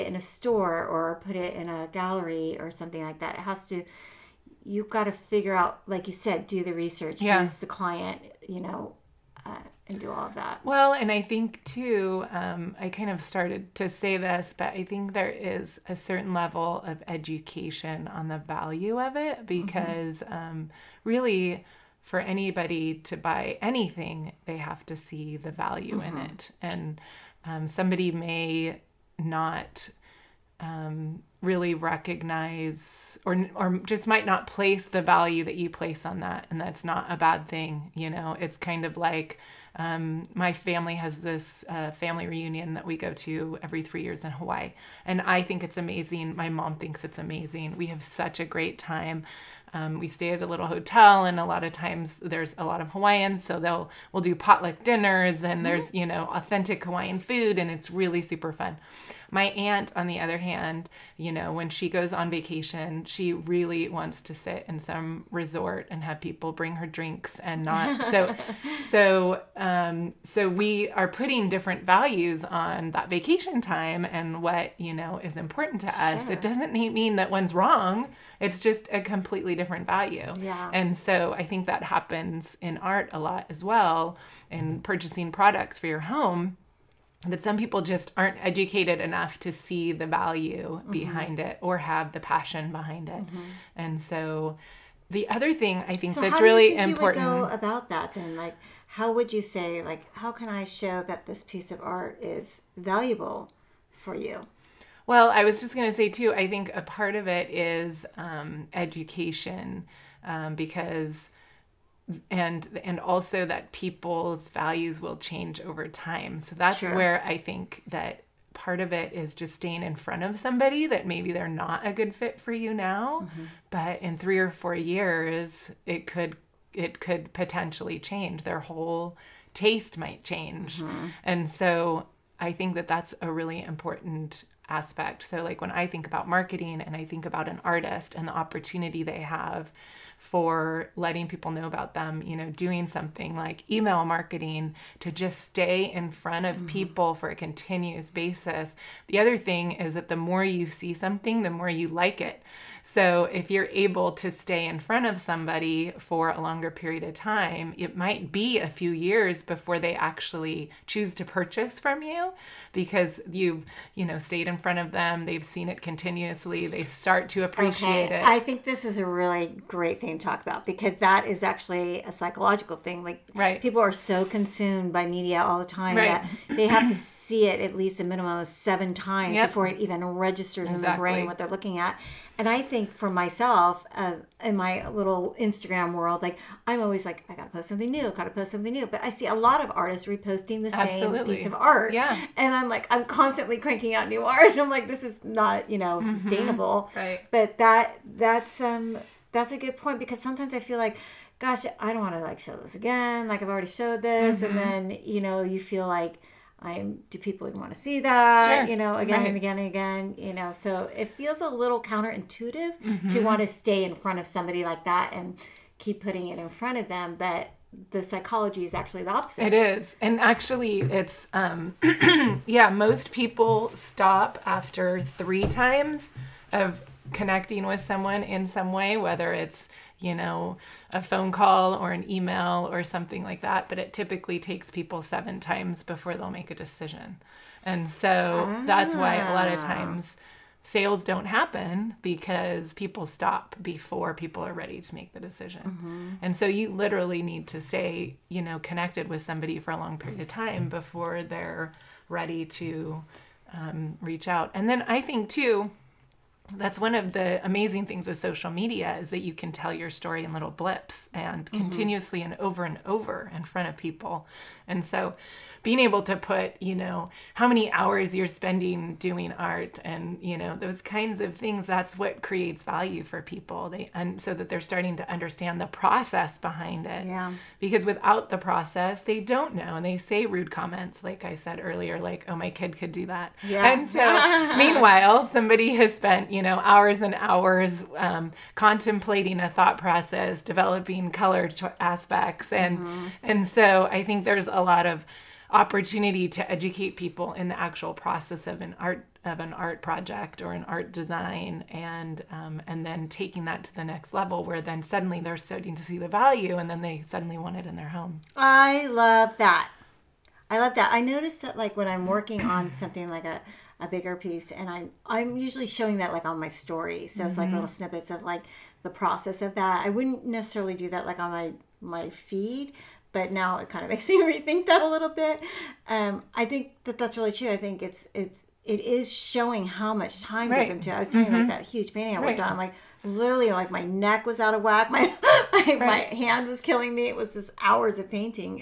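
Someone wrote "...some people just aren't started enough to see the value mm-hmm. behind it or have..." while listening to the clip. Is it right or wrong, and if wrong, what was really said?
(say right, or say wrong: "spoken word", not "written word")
wrong: "educated", not "started".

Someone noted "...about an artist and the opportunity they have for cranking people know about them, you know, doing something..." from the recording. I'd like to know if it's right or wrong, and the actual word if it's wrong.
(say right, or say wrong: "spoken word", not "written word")
wrong: "letting", not "cranking".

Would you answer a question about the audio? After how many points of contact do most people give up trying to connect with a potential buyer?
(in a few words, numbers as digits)
3.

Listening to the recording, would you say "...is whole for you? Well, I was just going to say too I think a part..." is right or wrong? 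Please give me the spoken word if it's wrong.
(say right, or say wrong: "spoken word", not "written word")
wrong: "valuable", not "whole".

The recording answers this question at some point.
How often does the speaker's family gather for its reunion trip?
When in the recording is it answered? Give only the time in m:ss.
0:43.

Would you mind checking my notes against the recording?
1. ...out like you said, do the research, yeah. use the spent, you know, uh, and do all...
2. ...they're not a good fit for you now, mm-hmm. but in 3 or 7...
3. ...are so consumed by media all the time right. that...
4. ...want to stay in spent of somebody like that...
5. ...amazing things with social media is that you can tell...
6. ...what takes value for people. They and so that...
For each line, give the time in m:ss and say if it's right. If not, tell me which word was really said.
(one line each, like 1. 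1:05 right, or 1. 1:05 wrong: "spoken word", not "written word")
1. 0:05 wrong: "client", not "spent"
2. 2:01 wrong: "4", not "7"
3. 2:53 right
4. 3:33 wrong: "front", not "spent"
5. 4:17 right
6. 4:31 wrong: "creates", not "takes".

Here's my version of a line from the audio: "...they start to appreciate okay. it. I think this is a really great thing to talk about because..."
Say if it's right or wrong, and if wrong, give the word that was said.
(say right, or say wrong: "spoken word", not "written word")
right.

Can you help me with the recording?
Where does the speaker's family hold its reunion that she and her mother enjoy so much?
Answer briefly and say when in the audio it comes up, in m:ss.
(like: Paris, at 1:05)
Hawaii, at 0:44.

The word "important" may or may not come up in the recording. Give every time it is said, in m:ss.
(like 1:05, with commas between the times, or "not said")
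1:15, 1:36, 2:13.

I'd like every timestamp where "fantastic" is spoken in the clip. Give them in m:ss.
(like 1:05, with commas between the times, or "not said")
not said.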